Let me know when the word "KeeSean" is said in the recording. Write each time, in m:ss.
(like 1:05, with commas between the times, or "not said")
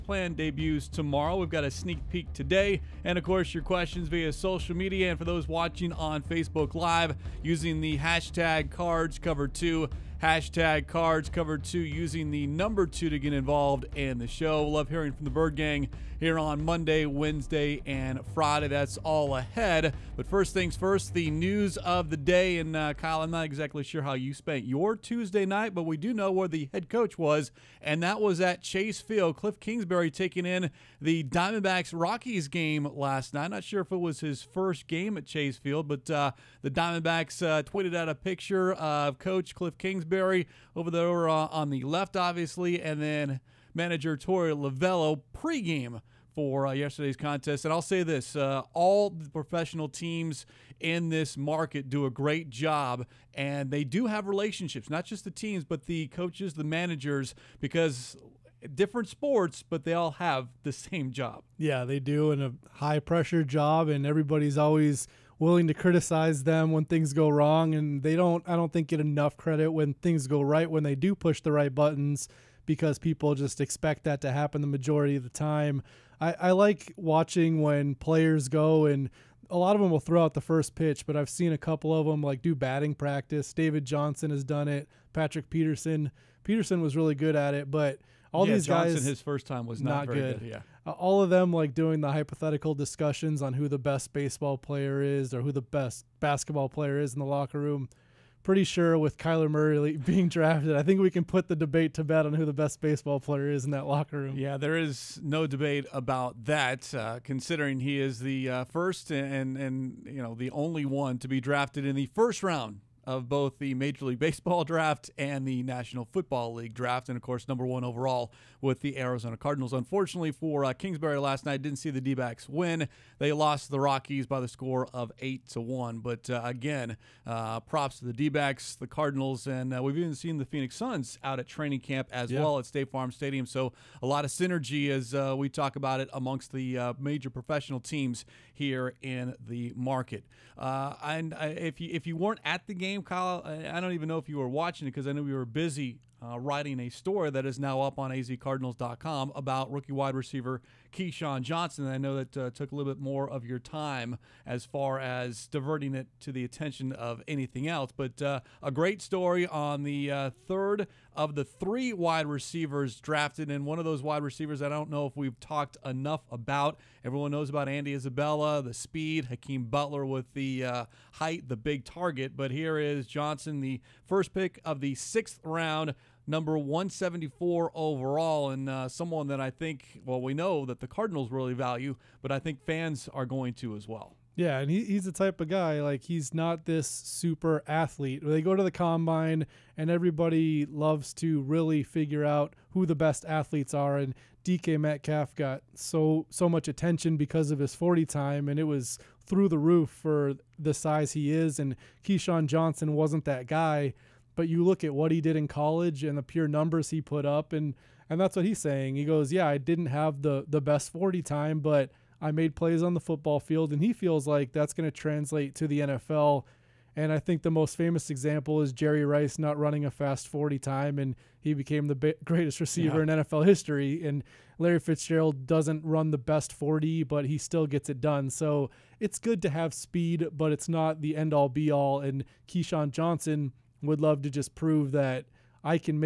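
2:30, 3:22, 3:52.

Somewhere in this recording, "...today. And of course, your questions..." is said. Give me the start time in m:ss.
0:02.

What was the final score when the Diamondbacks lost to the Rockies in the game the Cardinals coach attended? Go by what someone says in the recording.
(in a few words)
8 to 1.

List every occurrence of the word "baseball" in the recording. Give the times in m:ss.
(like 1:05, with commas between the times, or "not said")
1:34, 1:42, 1:54.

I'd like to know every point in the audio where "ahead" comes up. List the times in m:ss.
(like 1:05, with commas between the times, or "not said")
0:19.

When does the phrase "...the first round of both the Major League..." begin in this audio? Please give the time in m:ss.
1:51.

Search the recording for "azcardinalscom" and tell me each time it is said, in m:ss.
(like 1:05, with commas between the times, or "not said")
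2:28.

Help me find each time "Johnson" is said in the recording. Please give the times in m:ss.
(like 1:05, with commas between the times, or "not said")
1:23, 1:28, 2:31, 2:53, 3:22, 3:52.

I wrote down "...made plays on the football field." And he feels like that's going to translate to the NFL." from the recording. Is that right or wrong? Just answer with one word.
right.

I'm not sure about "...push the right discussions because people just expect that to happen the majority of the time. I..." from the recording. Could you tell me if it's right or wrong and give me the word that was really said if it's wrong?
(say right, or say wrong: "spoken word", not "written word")
wrong: "buttons", not "discussions".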